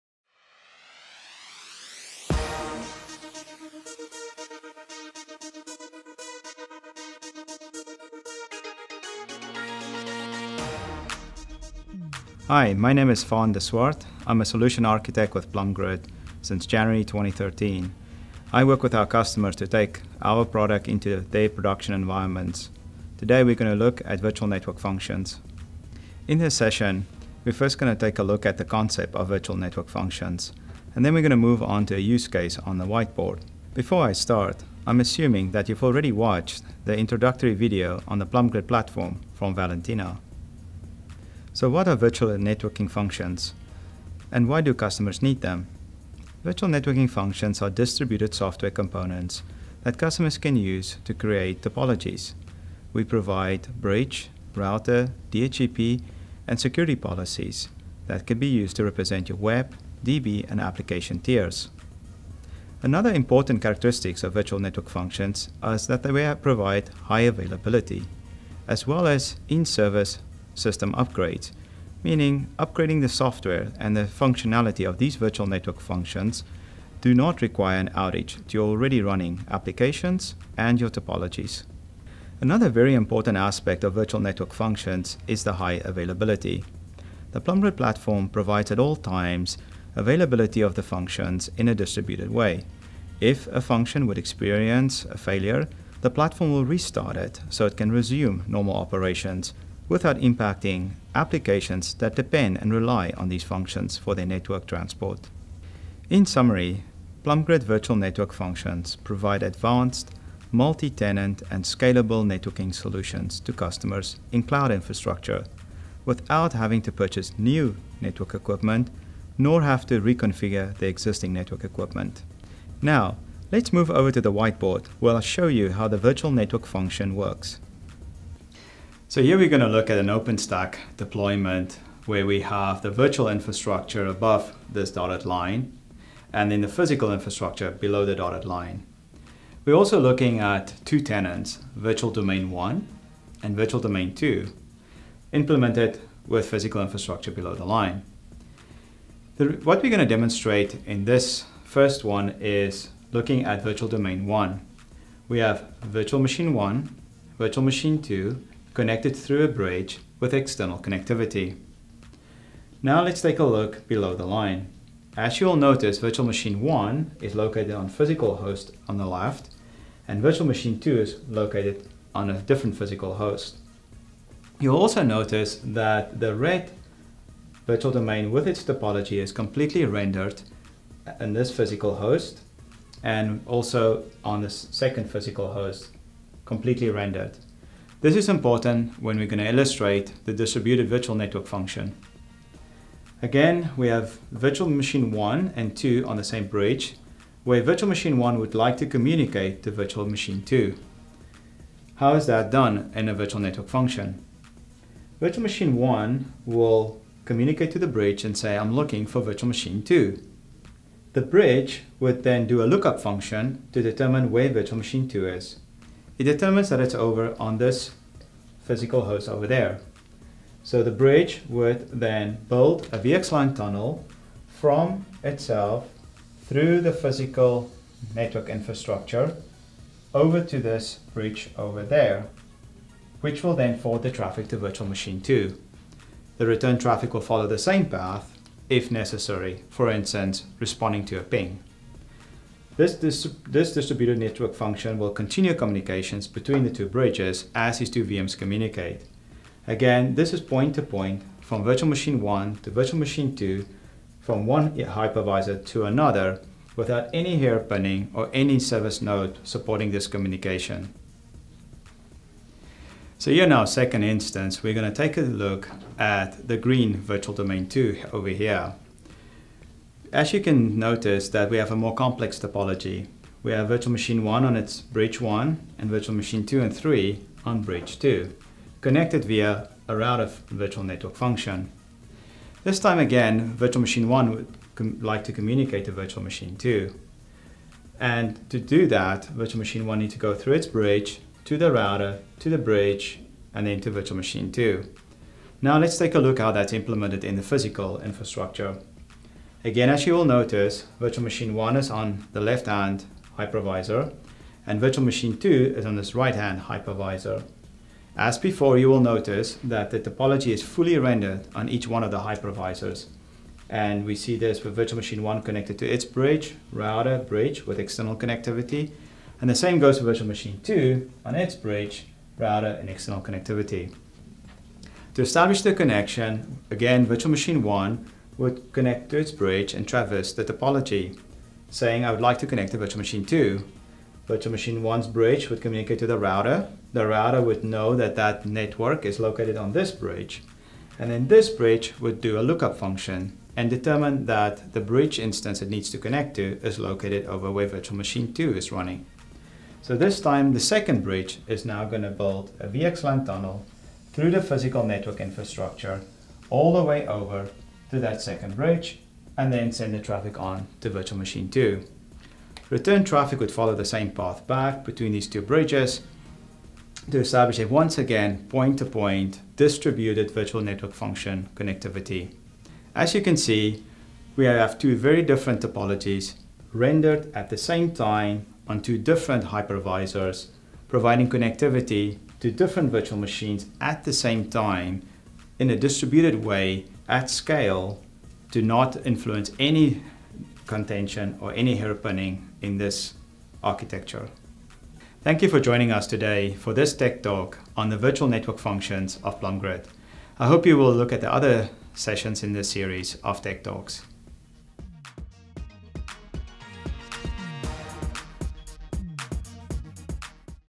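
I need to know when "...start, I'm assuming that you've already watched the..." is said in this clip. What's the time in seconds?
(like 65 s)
34 s.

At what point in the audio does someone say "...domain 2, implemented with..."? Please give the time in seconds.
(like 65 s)
143 s.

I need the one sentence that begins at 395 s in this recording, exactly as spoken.
Thank you for joining us today for this tech talk on the virtual network functions of PLUMgrid.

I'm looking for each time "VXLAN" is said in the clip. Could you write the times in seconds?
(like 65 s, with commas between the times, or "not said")
222 s, 352 s.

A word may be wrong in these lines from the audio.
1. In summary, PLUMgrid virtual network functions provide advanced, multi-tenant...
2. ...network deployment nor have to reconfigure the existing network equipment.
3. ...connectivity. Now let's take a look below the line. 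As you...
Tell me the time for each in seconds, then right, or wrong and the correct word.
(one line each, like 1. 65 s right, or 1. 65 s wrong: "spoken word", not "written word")
1. 106 s right
2. 117 s wrong: "equipment", not "deployment"
3. 160 s right.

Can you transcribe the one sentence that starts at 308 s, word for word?
As before, you will notice that the topology is fully rendered on each one of the hypervisors.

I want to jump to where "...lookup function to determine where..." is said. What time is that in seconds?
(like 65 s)
212 s.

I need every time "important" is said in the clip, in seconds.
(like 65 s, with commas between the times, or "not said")
63 s, 82 s, 188 s.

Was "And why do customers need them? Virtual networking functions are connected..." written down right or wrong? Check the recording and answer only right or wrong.
wrong.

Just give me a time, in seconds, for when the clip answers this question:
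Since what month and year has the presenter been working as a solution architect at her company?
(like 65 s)
16 s.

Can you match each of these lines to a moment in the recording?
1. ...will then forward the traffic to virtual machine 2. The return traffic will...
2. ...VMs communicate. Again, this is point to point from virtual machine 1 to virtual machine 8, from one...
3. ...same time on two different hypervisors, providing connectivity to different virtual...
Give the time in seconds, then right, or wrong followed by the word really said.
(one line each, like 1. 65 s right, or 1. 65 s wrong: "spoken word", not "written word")
1. 233 s right
2. 248 s wrong: "2", not "8"
3. 377 s right.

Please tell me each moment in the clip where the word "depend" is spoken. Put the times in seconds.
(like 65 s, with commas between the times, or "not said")
102 s.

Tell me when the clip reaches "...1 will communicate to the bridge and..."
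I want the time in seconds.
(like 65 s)
205 s.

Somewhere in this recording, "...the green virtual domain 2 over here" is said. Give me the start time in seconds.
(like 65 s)
266 s.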